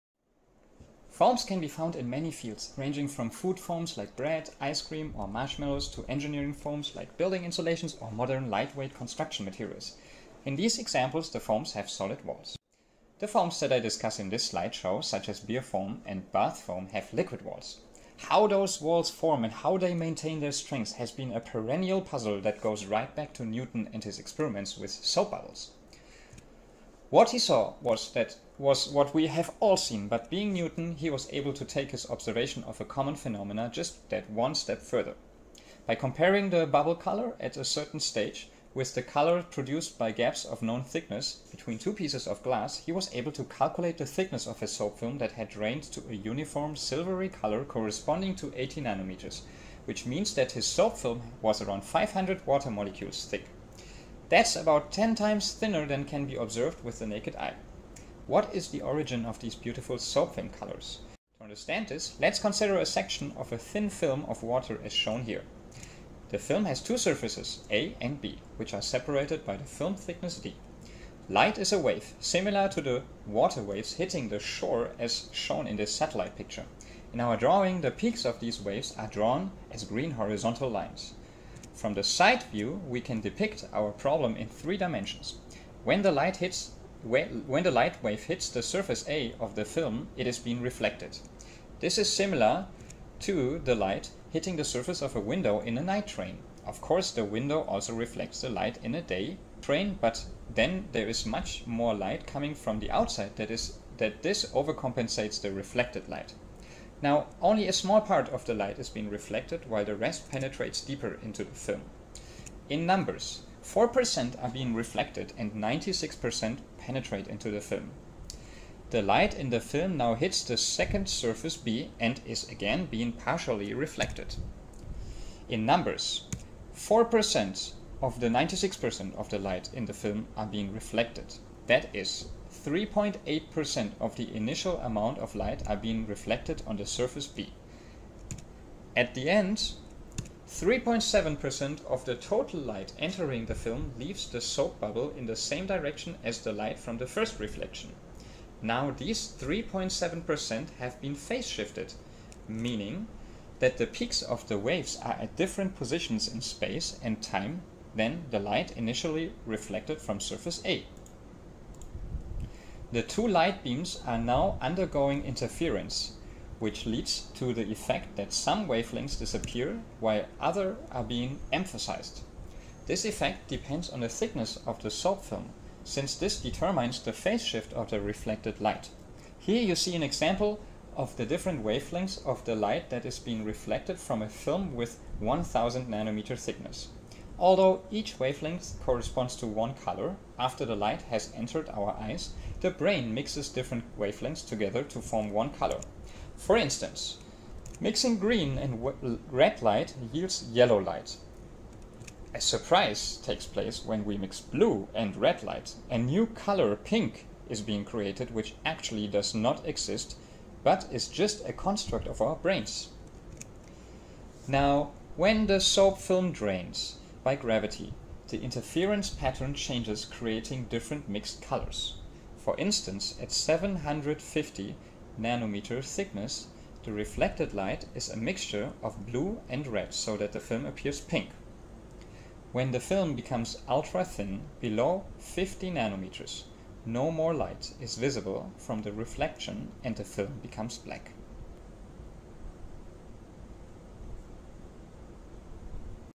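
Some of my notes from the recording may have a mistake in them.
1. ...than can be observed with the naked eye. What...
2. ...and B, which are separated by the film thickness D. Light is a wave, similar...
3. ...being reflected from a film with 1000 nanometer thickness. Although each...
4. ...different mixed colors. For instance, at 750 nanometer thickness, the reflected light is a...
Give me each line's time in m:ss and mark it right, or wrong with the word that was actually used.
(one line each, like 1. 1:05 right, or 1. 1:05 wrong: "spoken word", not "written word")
1. 0:55 right
2. 1:07 right
3. 3:03 right
4. 3:40 right.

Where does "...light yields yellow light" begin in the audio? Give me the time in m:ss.
3:19.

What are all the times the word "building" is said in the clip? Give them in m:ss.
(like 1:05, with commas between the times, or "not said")
0:07.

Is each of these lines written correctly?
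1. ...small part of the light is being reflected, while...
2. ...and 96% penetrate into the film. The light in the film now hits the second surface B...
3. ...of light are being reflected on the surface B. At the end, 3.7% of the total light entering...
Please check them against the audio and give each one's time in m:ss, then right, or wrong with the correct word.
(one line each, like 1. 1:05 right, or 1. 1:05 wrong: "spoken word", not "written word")
1. 1:47 right
2. 1:55 right
3. 2:15 right.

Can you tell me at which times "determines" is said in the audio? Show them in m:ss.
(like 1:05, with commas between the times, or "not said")
2:56.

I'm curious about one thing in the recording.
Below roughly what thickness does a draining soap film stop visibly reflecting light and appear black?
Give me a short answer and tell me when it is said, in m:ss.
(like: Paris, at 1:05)
50 nanometers, at 3:55.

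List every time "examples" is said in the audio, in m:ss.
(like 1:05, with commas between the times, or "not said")
0:10, 3:00.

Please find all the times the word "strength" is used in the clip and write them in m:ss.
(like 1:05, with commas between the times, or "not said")
0:20.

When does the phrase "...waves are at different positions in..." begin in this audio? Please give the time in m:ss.
2:34.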